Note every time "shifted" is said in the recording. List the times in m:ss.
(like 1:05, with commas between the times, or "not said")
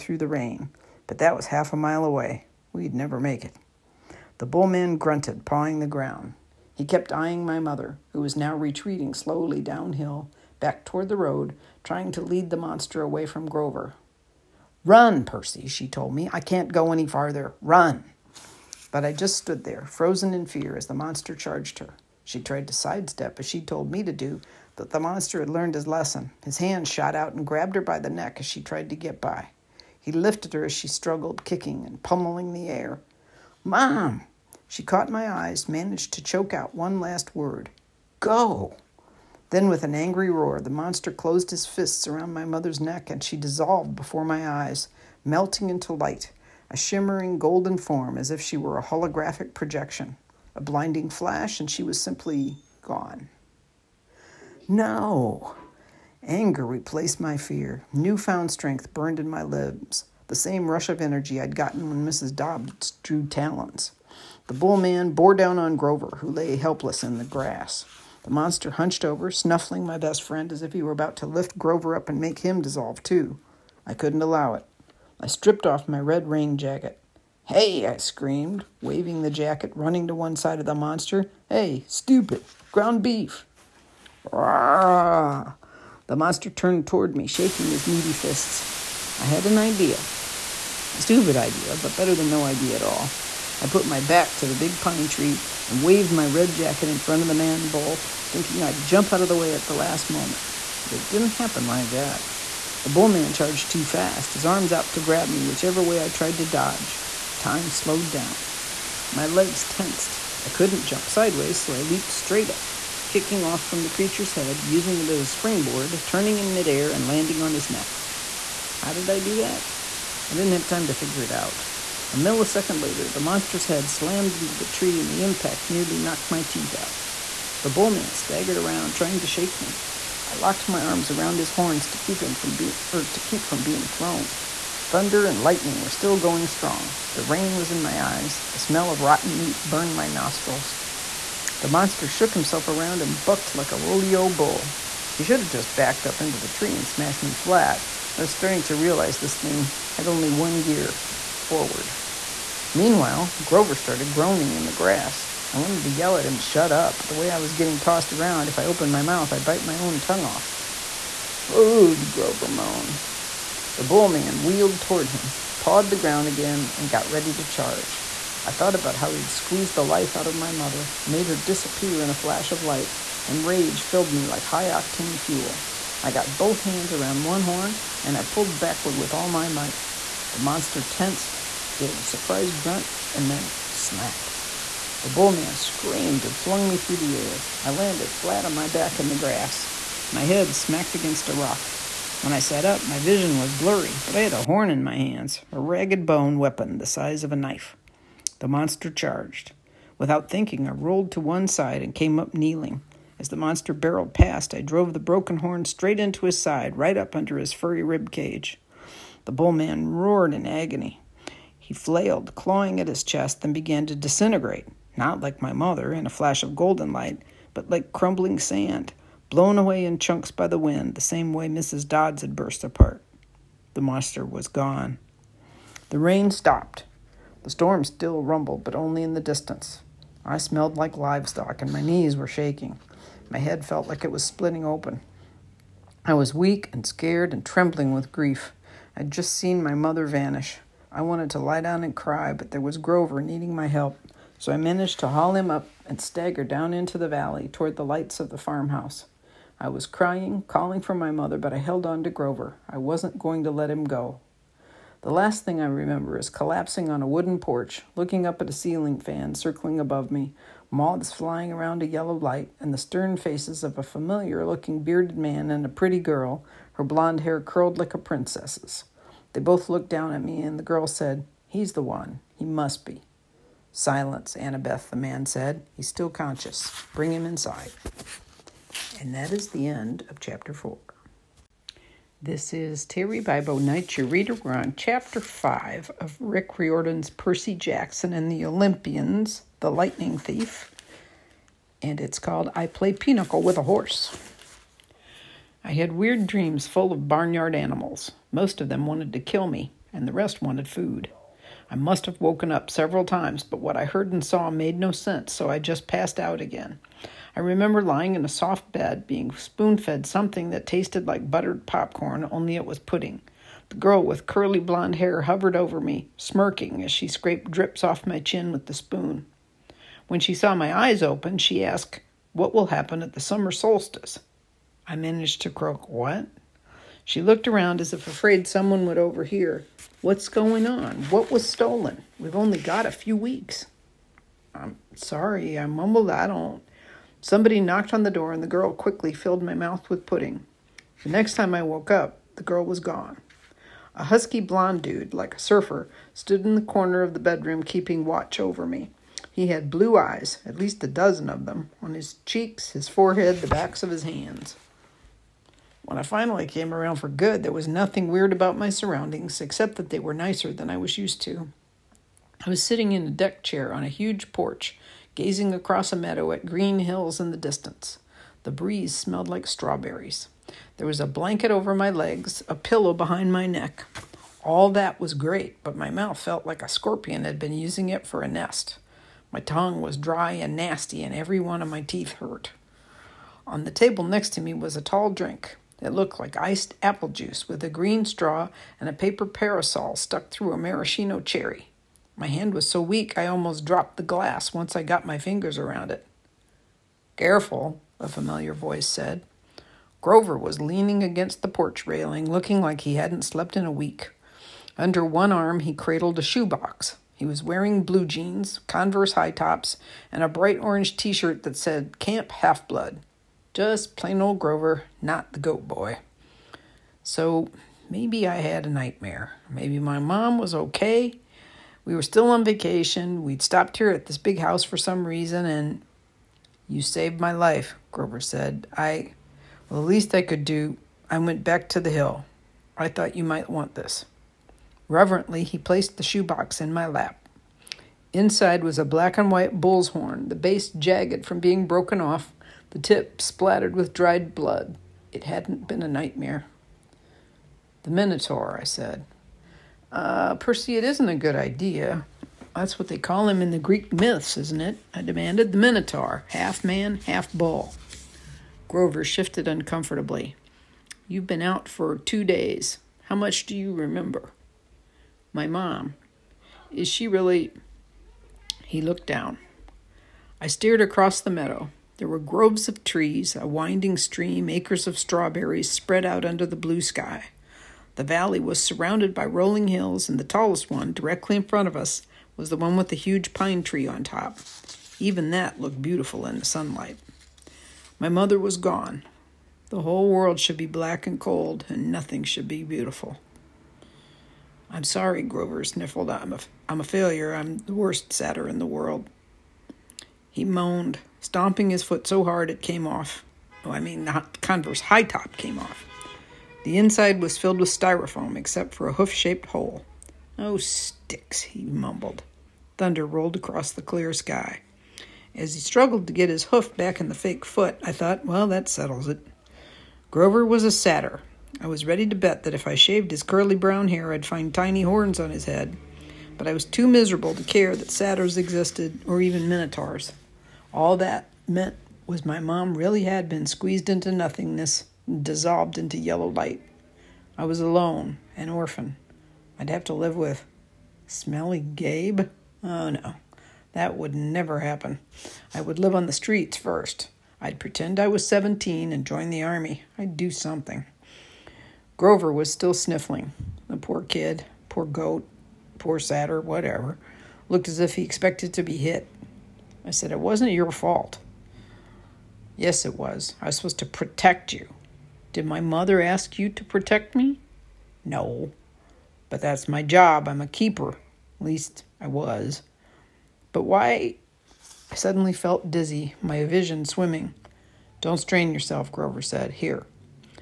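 7:39.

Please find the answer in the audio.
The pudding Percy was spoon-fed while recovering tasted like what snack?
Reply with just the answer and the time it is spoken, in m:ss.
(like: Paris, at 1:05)
buttered popcorn, at 5:11.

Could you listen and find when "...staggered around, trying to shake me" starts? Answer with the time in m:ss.
2:08.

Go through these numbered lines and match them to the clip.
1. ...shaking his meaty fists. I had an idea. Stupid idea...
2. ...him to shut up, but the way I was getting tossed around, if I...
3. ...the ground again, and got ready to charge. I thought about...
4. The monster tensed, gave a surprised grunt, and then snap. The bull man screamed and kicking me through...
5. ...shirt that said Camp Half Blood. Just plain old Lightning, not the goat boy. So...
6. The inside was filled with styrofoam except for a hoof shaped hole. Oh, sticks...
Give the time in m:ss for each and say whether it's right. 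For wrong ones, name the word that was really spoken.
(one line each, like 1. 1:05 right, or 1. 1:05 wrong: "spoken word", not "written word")
1. 1:27 right
2. 2:36 right
3. 2:45 right
4. 3:00 wrong: "flung", not "kicking"
5. 6:51 wrong: "Grover", not "Lightning"
6. 8:26 right.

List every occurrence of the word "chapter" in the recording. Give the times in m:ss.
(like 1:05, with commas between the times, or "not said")
4:40, 4:44.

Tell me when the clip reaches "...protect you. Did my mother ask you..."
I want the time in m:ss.
9:23.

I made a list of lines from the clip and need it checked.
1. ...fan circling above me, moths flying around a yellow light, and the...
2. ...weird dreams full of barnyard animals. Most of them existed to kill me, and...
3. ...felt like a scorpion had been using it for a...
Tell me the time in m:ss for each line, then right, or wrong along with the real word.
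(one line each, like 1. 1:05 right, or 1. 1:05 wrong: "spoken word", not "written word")
1. 4:18 right
2. 4:55 wrong: "wanted", not "existed"
3. 6:16 right.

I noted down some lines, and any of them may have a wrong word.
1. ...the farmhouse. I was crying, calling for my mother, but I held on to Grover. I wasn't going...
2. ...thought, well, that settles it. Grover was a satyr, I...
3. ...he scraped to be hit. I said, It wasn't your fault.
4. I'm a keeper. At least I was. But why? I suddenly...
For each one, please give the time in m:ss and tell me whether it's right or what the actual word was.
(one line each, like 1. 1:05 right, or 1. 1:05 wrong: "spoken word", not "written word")
1. 4:08 right
2. 8:37 right
3. 9:17 wrong: "expected", not "scraped"
4. 9:30 right.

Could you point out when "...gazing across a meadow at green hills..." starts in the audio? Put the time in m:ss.
6:05.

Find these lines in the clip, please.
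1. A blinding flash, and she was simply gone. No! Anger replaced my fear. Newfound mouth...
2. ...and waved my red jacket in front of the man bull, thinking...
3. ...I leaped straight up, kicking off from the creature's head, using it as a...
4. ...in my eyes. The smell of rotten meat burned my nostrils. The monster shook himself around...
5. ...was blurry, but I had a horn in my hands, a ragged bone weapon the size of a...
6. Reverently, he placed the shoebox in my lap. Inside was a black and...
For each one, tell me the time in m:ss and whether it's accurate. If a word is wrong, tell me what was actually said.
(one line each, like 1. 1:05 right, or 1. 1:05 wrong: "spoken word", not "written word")
1. 0:50 wrong: "strength", not "mouth"
2. 1:35 right
3. 1:51 right
4. 2:17 right
5. 3:13 right
6. 7:14 right.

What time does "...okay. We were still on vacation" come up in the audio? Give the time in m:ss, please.
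7:00.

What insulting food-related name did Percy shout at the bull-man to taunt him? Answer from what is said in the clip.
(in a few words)
ground beef.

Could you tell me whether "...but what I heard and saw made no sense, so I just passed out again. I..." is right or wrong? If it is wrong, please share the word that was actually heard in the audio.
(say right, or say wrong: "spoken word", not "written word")
right.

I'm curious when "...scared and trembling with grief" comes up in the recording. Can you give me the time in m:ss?
3:56.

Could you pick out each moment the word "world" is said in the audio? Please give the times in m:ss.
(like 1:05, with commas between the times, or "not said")
8:10, 8:18.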